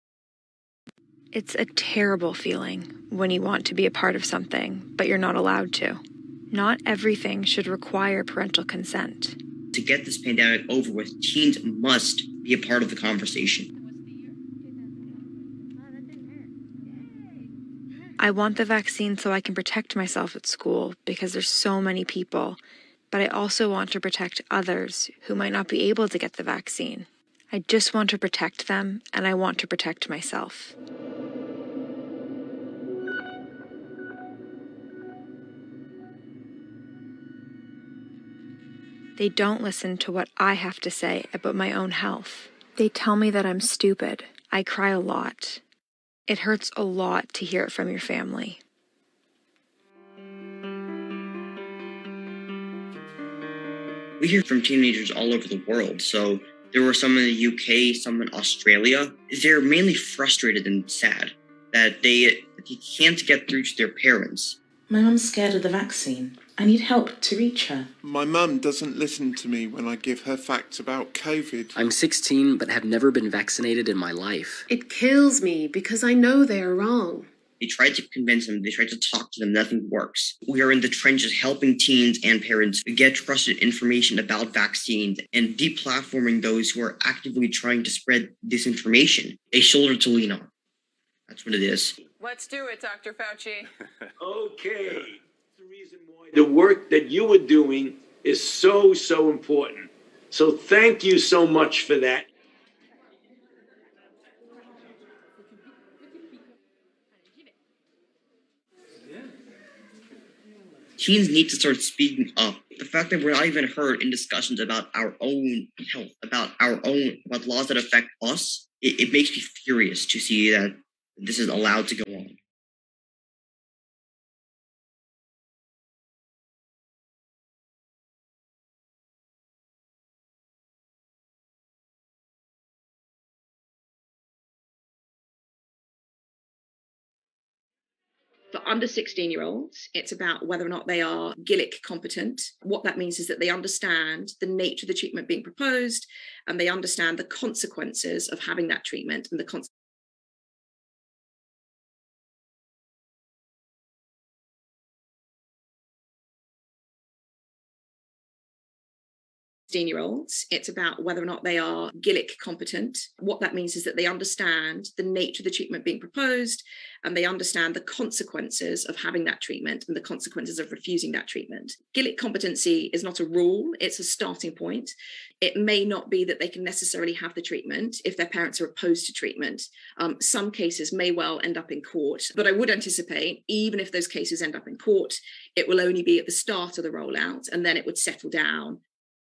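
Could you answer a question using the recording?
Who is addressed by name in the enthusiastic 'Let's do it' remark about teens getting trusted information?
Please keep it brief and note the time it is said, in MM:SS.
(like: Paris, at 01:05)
Dr. Fauci, at 01:32.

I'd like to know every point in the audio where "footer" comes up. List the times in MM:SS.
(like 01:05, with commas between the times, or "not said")
not said.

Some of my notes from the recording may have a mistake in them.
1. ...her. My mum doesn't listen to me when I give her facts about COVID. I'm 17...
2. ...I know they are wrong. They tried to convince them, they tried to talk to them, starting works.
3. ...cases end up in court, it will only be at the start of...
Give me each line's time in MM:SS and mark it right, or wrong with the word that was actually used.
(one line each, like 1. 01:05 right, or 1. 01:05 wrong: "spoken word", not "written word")
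1. 01:07 wrong: "16", not "17"
2. 01:16 wrong: "nothing", not "starting"
3. 03:04 right.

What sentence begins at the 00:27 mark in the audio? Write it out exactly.
I just want to protect them and I want to protect myself.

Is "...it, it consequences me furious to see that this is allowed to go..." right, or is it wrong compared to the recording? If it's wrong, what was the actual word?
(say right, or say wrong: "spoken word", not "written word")
wrong: "makes", not "consequences".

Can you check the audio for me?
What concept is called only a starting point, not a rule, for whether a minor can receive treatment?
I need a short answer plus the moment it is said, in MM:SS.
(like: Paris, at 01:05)
Gillick competency, at 02:51.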